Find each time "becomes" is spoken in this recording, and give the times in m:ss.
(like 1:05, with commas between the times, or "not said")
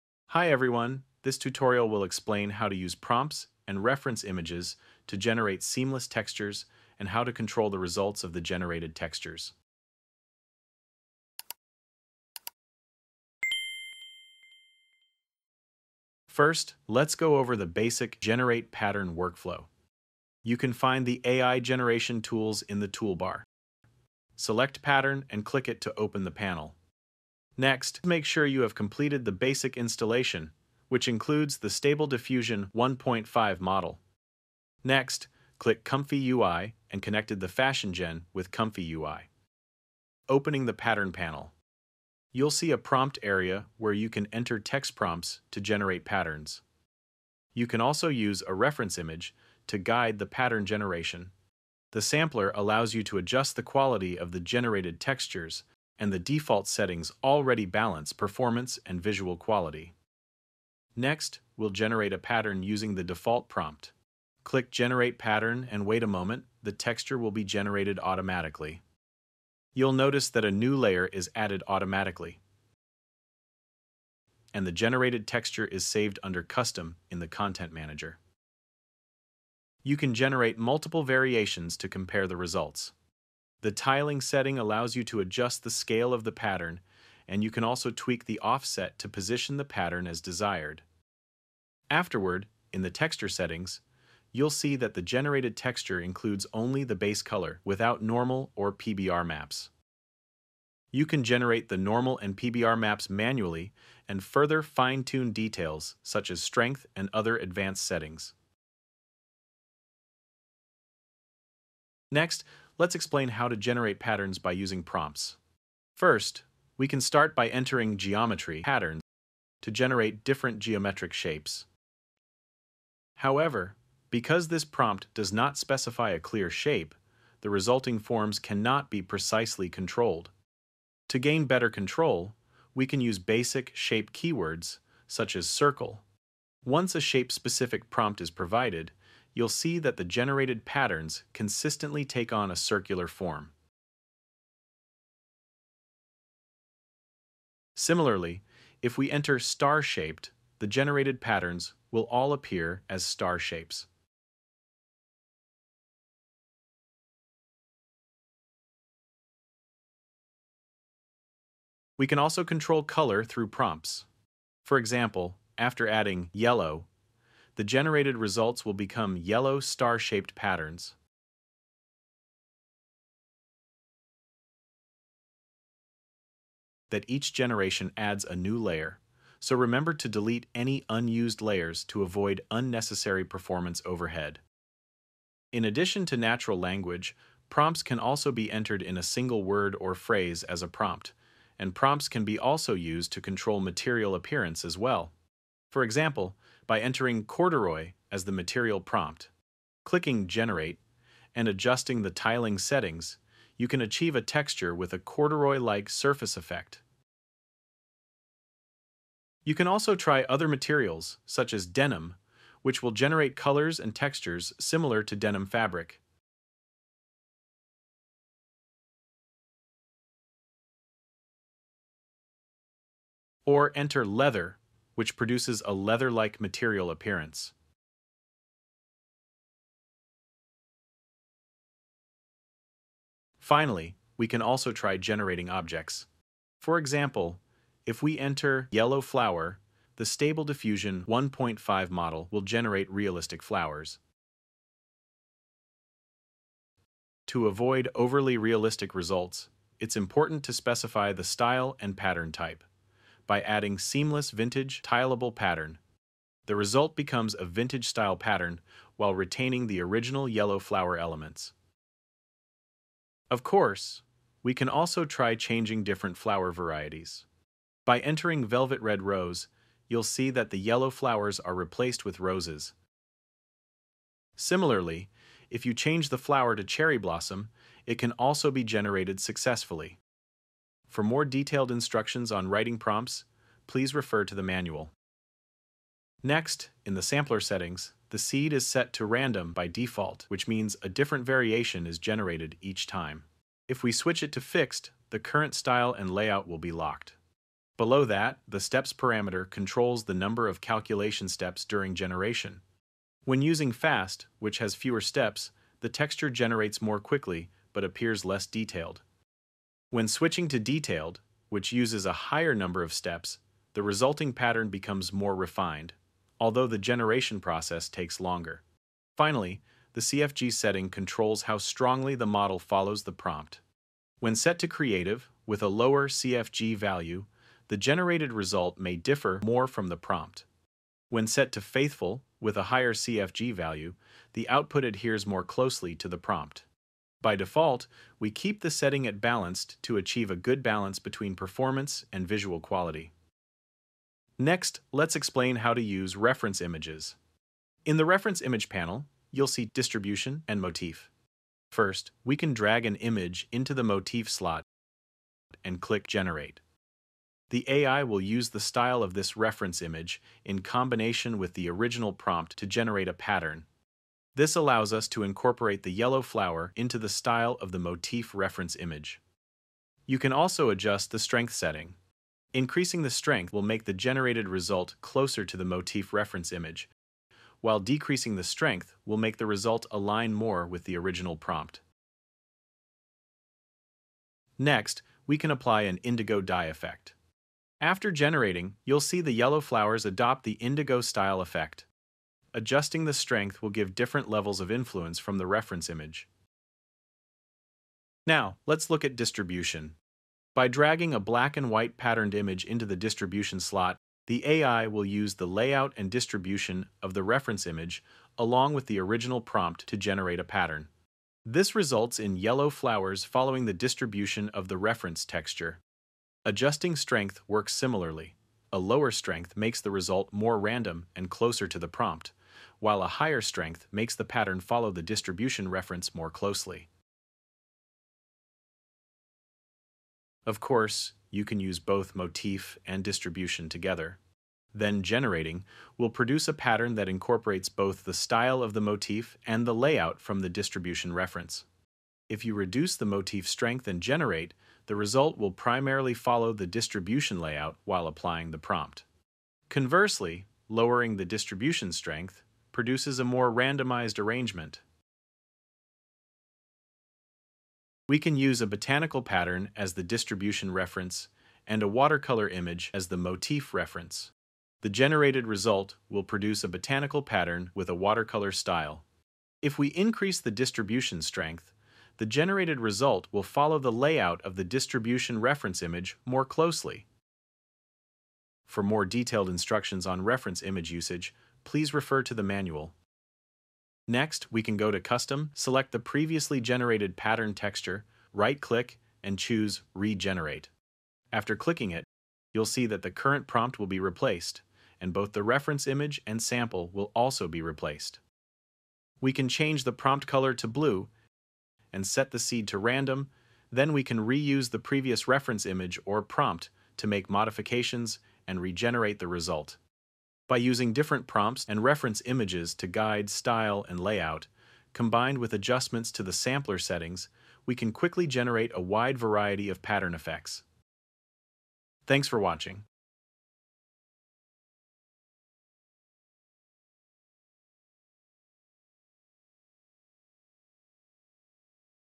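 2:48, 4:16, 5:14.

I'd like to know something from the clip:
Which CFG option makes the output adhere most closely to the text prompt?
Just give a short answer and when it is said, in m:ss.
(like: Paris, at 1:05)
faithful, at 5:31.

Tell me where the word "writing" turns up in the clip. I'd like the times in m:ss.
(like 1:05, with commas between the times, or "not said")
4:42.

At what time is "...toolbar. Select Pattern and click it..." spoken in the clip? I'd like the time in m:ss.
0:22.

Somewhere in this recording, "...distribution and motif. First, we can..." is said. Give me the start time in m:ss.
5:49.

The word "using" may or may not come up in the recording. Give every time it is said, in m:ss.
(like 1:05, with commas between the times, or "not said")
1:02, 1:54, 5:03, 8:30.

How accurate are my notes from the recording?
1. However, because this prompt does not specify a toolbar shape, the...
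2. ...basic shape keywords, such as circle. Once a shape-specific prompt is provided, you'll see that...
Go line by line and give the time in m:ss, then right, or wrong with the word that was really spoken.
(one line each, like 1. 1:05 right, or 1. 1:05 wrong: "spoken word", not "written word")
1. 2:03 wrong: "clear", not "toolbar"
2. 2:13 right.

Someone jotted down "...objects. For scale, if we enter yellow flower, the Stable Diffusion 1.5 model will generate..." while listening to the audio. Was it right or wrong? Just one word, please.
wrong.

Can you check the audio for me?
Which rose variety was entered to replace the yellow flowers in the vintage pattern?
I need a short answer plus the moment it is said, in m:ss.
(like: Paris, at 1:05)
Velvet Red Rose, at 4:28.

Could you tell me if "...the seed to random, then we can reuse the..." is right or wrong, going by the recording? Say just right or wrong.
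right.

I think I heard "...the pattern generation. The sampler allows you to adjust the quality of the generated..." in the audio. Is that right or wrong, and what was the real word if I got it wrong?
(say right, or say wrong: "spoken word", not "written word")
right.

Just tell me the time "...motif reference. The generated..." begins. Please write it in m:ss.
7:43.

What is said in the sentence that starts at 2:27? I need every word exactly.
Similarly, if we enter star-shaped, the generated patterns will all appear as star shapes.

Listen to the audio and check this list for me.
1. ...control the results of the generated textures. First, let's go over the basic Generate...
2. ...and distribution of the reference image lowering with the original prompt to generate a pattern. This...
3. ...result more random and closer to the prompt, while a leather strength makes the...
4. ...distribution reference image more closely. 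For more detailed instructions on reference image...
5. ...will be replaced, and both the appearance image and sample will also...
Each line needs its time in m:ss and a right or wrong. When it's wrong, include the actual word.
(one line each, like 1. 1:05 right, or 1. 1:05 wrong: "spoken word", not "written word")
1. 0:07 right
2. 6:45 wrong: "along", not "lowering"
3. 6:59 wrong: "higher", not "leather"
4. 7:54 right
5. 8:13 wrong: "reference", not "appearance".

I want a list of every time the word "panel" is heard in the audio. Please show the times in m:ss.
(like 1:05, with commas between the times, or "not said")
0:26, 0:41, 5:48.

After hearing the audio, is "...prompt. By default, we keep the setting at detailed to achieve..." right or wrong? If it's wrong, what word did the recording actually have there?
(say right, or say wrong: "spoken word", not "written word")
wrong: "balanced", not "detailed".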